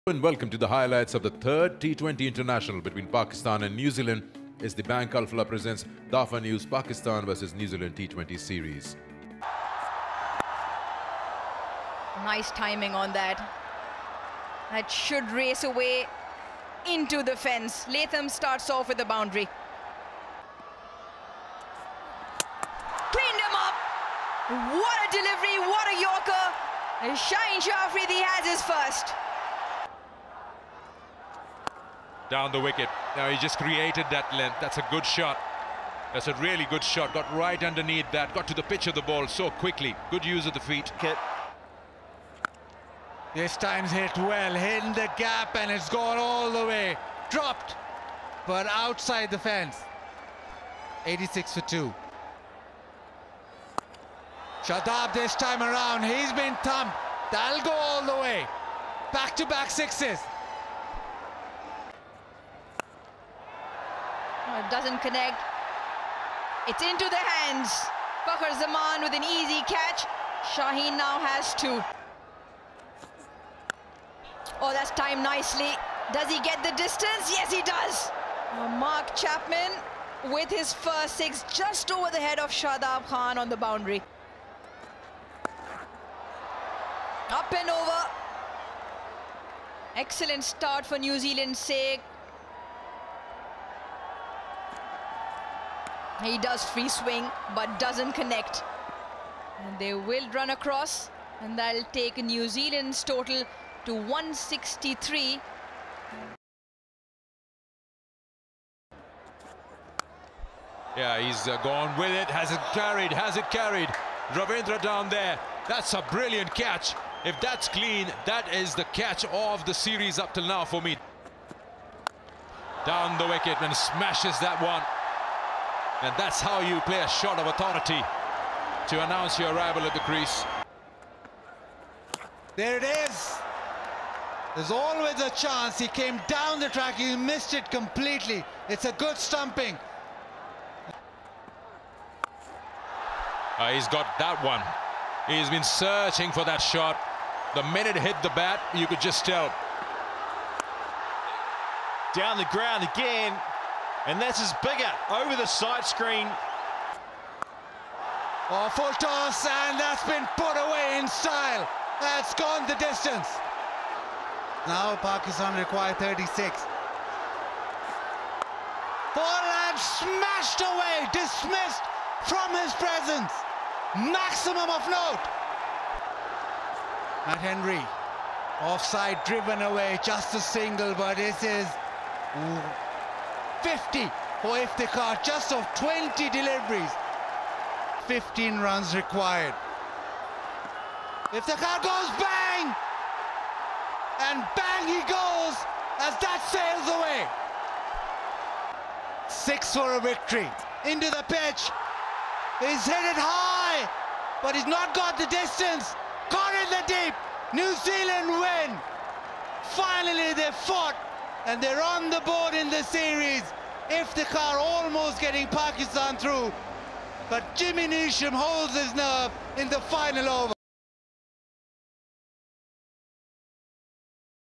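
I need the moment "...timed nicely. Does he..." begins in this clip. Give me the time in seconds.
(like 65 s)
74 s.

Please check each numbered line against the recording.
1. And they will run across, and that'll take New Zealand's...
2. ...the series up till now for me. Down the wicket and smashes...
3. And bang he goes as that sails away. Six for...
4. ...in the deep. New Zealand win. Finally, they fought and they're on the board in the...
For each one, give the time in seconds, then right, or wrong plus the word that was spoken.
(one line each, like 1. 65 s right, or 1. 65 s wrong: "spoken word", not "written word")
1. 99 s right
2. 119 s right
3. 194 s right
4. 206 s right.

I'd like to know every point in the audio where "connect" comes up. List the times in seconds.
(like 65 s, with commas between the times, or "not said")
65 s, 98 s.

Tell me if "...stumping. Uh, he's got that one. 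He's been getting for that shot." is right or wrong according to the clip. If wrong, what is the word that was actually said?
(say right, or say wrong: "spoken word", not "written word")
wrong: "searching", not "getting".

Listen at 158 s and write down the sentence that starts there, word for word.
Oh, full toss, and that's been put away in style.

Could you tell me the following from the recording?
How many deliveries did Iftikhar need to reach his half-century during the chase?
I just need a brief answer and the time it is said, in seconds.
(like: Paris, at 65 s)
20, at 185 s.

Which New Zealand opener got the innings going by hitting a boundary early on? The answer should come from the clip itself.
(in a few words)
Latham.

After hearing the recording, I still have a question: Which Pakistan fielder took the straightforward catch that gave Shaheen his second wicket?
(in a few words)
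Fakhar Zaman.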